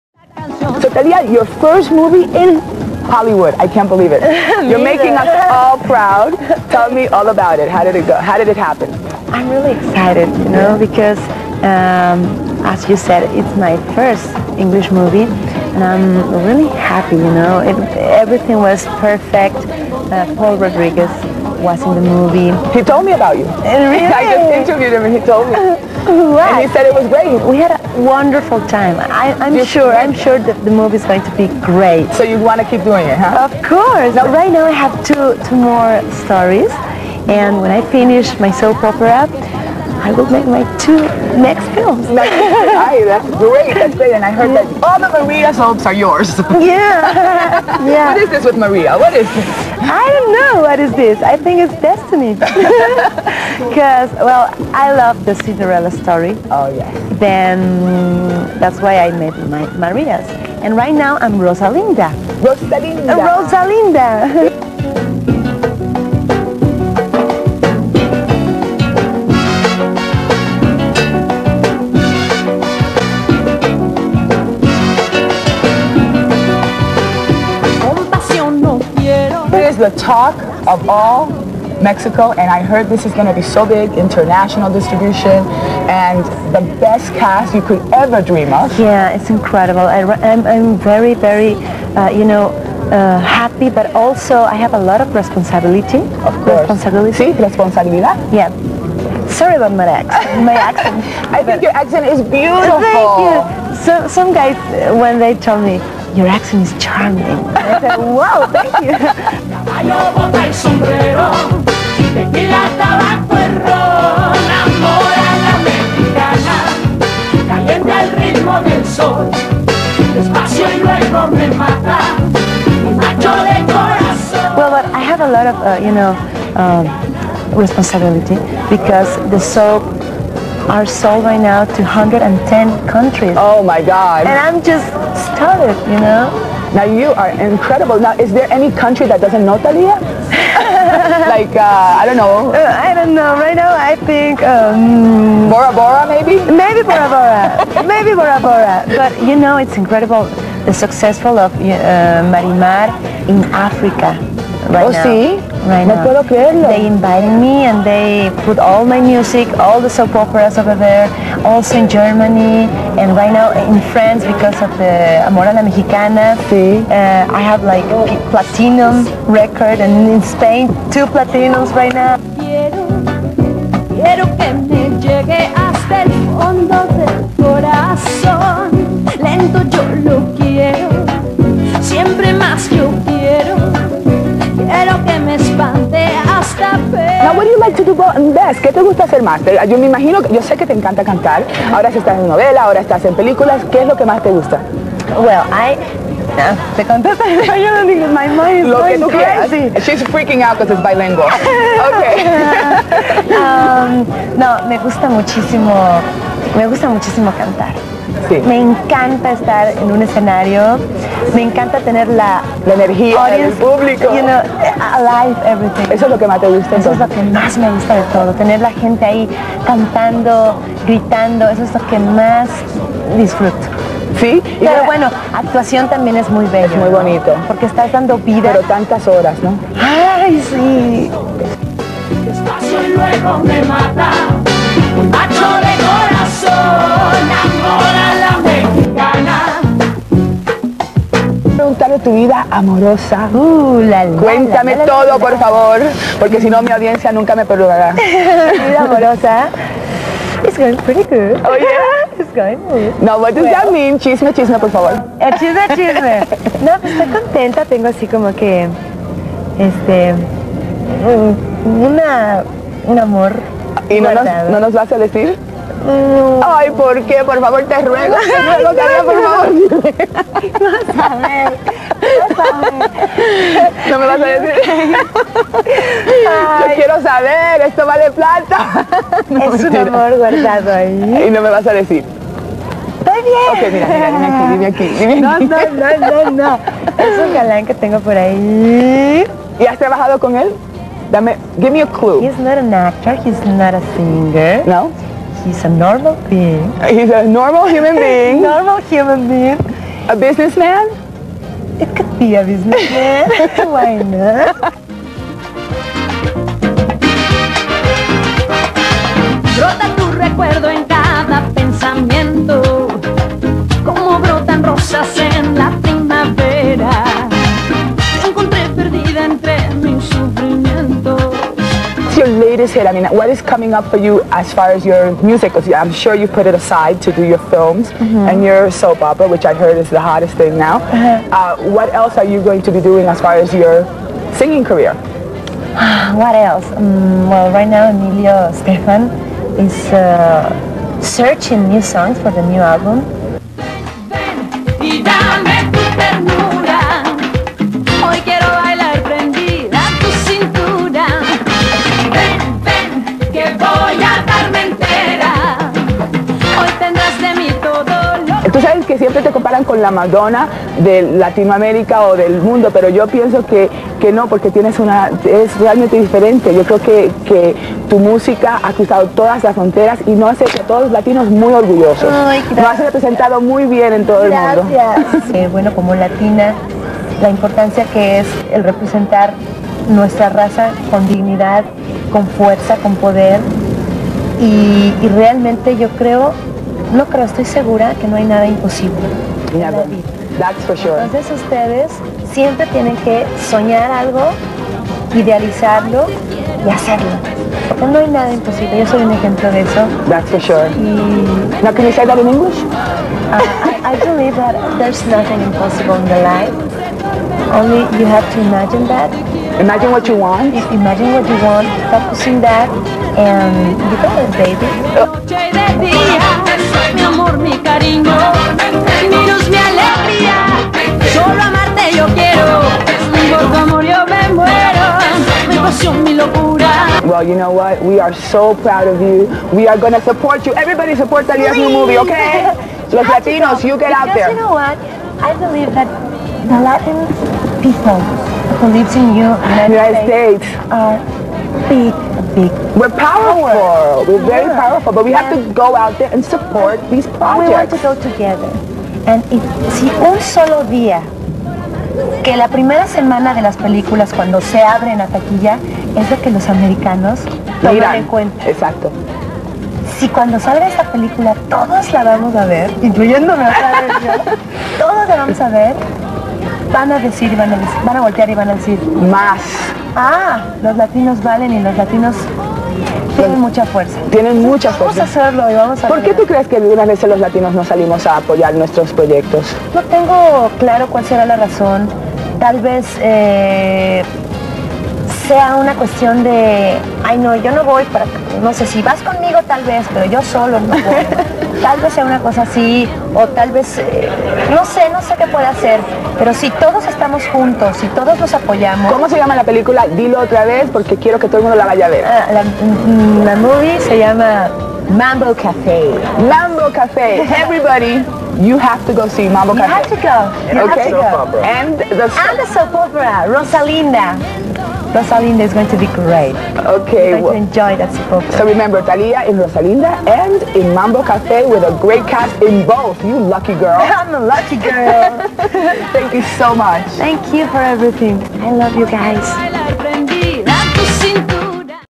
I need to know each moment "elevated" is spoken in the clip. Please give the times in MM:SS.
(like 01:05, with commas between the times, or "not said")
not said.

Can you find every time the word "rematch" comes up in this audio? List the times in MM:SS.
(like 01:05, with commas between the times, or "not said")
not said.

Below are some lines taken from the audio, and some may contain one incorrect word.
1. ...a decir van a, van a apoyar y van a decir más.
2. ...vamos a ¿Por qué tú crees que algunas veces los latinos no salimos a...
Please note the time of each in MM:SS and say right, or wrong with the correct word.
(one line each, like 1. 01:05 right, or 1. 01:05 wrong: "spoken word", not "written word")
1. 07:46 wrong: "voltear", not "apoyar"
2. 07:55 right.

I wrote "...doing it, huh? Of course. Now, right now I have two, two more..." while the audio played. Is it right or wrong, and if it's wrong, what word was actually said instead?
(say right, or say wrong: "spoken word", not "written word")
right.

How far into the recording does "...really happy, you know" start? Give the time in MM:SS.
00:16.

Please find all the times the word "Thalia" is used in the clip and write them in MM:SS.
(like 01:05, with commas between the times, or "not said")
00:00, 02:19, 07:11, 08:38.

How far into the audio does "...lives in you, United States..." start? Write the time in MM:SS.
07:18.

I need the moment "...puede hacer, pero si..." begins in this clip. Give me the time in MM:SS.
08:15.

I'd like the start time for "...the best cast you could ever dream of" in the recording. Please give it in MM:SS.
01:26.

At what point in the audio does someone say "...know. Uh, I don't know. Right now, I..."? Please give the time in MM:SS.
02:22.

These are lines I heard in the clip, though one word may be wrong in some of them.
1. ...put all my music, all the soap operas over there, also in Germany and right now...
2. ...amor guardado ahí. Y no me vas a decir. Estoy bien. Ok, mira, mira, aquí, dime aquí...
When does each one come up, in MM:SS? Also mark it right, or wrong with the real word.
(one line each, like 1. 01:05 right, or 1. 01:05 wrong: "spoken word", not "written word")
1. 02:38 right
2. 04:39 right.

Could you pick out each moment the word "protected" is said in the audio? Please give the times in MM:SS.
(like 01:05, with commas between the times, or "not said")
not said.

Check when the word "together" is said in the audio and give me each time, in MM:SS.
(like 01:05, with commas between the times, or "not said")
07:28.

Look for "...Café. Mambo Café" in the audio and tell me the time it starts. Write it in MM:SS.
08:25.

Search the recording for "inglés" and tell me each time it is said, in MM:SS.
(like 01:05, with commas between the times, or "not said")
03:17.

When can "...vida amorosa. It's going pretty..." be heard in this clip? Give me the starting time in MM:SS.
04:08.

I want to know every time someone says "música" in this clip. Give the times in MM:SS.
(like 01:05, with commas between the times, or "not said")
06:07.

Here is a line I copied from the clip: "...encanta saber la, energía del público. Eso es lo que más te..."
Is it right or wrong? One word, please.
wrong.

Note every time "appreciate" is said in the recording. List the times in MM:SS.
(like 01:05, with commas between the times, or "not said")
not said.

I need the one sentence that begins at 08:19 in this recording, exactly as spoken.
Dilo otra vez porque quiero que todo el mundo la vaya a ver.